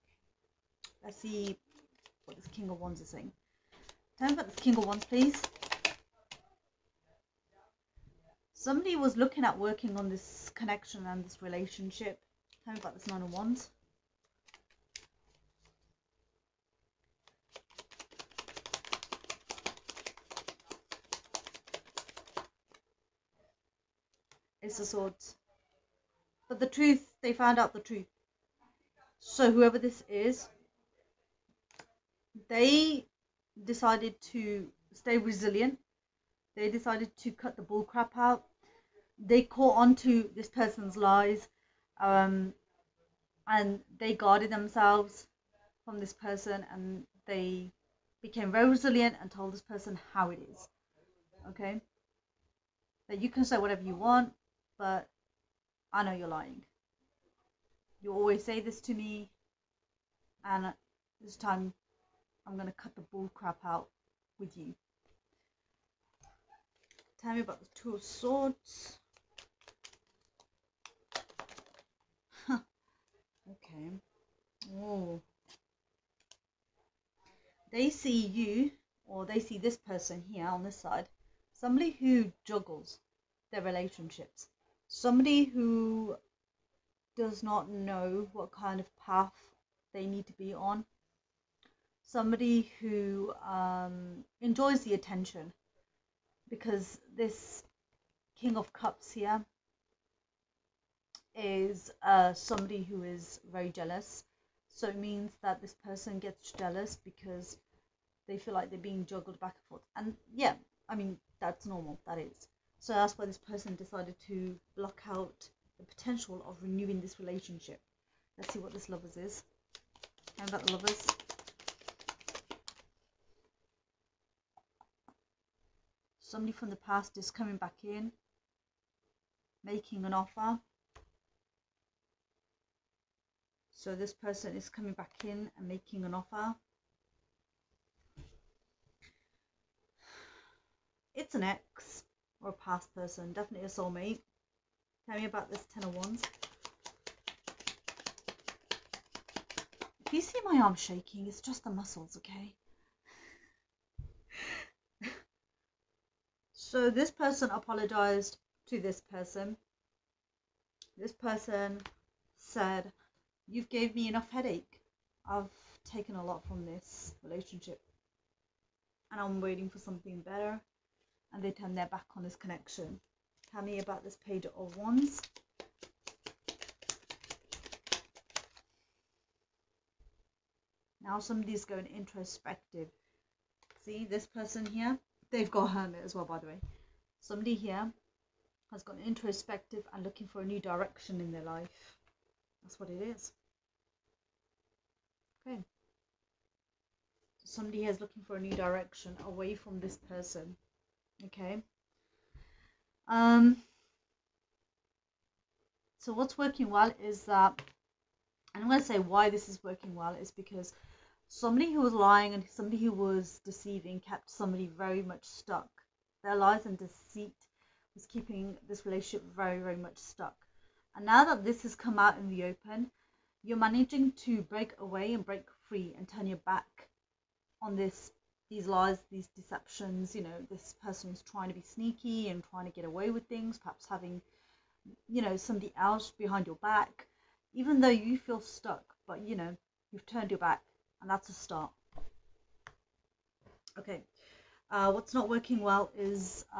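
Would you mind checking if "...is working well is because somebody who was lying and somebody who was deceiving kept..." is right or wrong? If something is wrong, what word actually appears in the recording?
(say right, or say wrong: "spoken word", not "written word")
right.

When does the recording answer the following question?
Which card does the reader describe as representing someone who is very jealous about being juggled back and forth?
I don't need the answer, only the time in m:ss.
1:38.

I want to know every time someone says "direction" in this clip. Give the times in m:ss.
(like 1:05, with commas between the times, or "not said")
3:10, 3:18.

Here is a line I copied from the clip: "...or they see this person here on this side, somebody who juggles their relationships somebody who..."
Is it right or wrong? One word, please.
right.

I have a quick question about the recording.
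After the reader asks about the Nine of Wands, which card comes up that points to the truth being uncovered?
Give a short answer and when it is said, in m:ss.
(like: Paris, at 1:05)
Ace of Swords, at 0:24.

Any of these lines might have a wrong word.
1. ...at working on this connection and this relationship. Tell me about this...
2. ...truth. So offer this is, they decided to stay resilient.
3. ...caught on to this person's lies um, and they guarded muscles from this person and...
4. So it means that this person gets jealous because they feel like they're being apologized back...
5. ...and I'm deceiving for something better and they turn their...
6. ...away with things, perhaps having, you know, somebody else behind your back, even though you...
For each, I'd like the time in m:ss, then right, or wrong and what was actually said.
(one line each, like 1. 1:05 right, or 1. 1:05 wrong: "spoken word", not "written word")
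1. 0:09 right
2. 0:27 wrong: "whoever", not "offer"
3. 0:39 wrong: "themselves", not "muscles"
4. 1:44 wrong: "juggled", not "apologized"
5. 2:49 wrong: "waiting", not "deceiving"
6. 3:52 right.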